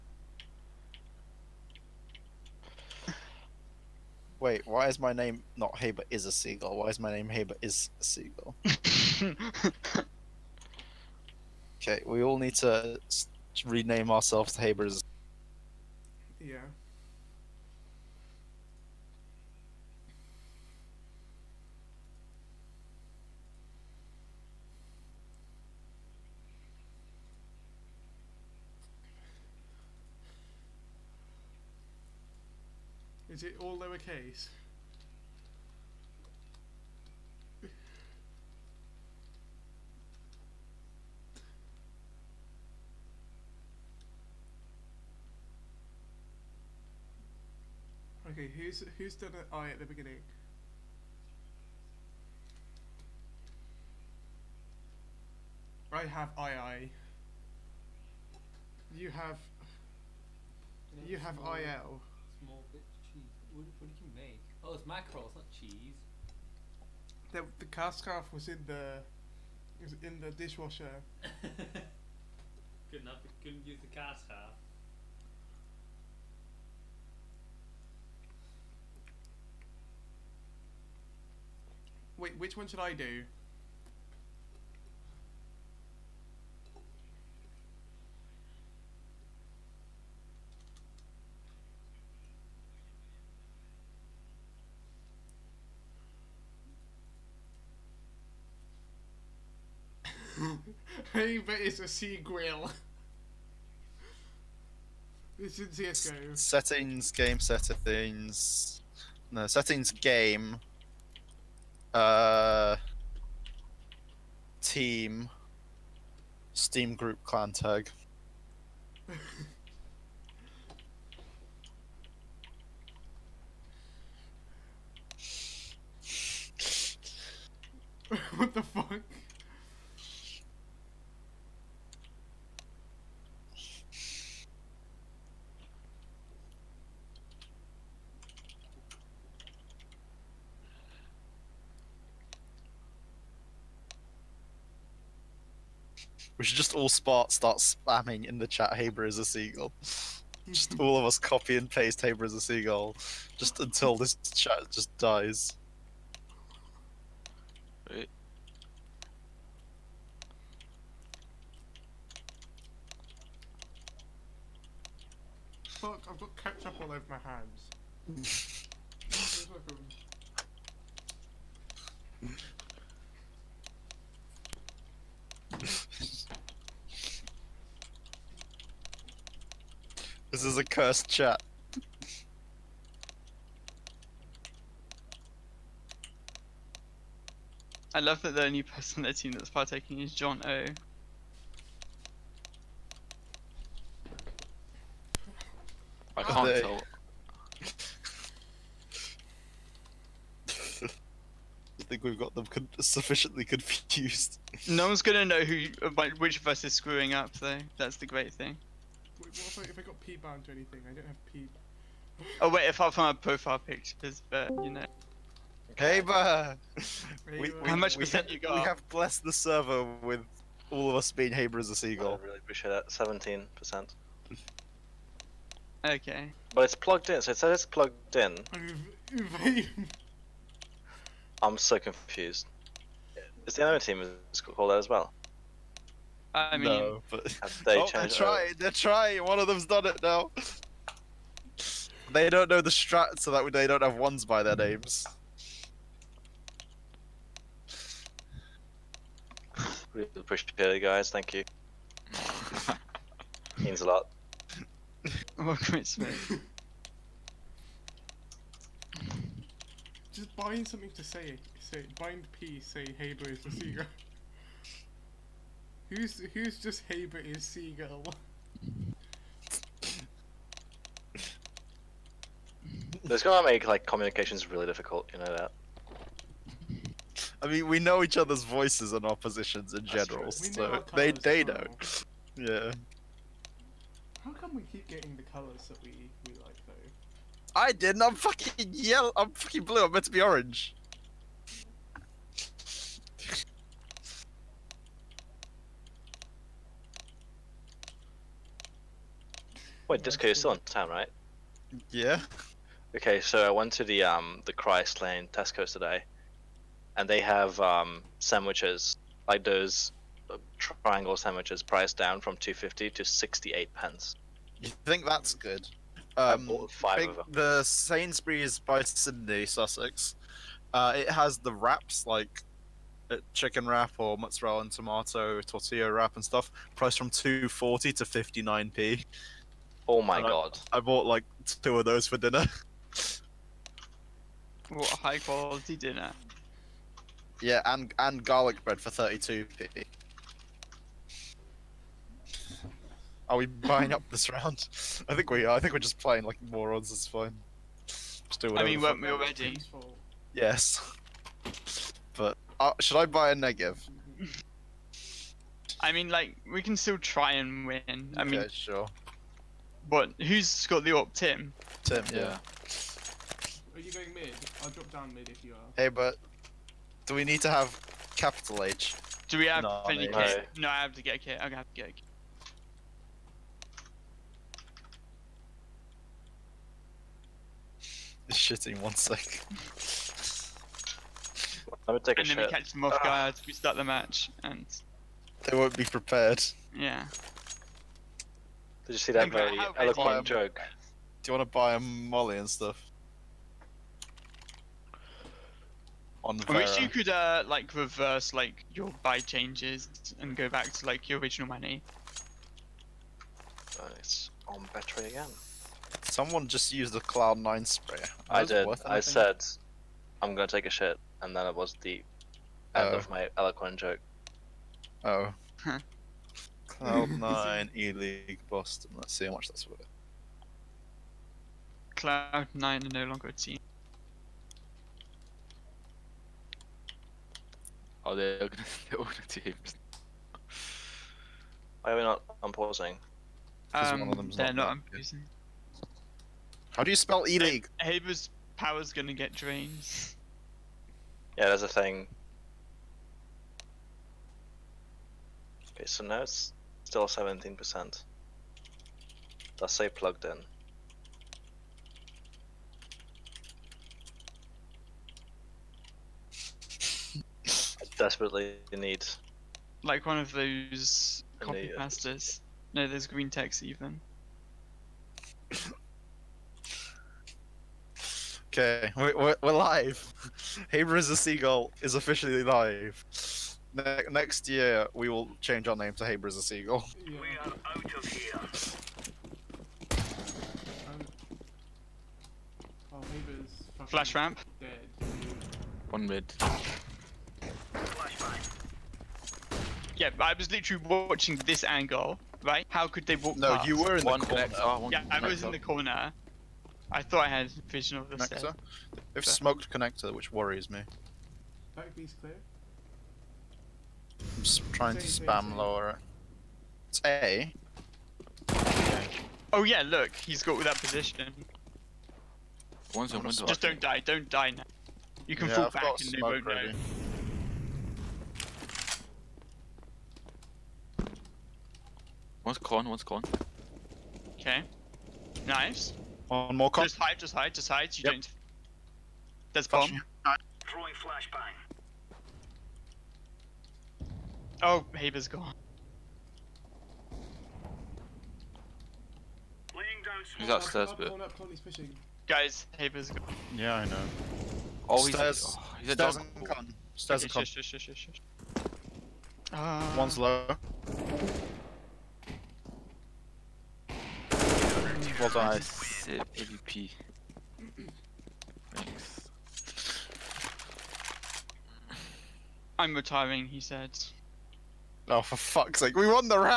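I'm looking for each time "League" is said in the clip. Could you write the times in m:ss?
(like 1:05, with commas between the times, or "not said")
6:57, 7:17.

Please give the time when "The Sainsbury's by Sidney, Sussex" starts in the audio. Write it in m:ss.
5:17.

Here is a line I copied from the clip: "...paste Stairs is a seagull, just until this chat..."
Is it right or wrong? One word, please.
wrong.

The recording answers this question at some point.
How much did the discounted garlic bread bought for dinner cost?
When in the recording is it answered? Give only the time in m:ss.
5:38.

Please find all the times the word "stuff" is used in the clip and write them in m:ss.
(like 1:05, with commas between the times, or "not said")
5:26, 6:32.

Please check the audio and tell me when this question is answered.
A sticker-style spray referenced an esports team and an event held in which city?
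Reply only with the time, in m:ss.
6:58.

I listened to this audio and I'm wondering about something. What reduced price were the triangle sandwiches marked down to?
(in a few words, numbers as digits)
68 pence.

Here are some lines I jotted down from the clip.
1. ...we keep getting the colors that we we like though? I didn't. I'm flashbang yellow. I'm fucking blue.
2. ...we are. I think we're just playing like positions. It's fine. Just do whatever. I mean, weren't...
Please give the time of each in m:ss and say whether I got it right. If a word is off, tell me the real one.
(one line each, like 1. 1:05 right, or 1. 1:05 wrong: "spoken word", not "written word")
1. 4:44 wrong: "fucking", not "flashbang"
2. 5:45 wrong: "morons", not "positions".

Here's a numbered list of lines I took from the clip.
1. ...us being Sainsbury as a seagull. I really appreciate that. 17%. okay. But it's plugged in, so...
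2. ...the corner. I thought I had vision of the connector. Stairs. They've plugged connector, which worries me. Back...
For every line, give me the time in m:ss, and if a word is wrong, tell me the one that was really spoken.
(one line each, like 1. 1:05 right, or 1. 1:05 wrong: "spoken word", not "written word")
1. 3:40 wrong: "Haber", not "Sainsbury"
2. 8:15 wrong: "smoked", not "plugged".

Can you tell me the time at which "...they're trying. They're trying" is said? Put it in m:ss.
3:57.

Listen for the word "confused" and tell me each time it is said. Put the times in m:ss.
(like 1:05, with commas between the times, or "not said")
3:23, 3:51.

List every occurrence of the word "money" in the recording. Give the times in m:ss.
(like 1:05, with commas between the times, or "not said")
6:41.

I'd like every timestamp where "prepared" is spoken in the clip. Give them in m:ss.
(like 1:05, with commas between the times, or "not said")
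6:25.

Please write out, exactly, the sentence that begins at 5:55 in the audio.
I mean, like we can still try and win.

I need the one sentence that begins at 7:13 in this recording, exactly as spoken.
Um, one of them's they're not, not unpausing.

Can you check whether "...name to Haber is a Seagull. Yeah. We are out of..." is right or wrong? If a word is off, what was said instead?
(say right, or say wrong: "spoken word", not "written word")
right.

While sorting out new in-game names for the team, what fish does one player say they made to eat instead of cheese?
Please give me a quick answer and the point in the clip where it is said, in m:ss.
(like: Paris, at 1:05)
Mackerel, at 1:04.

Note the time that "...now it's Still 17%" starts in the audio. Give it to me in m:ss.
7:26.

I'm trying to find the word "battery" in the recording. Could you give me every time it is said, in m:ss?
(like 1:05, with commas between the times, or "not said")
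6:44.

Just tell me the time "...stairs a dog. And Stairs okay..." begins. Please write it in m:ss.
9:05.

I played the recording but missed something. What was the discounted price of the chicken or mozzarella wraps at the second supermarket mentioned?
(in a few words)
59p.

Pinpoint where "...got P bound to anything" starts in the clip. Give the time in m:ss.
3:29.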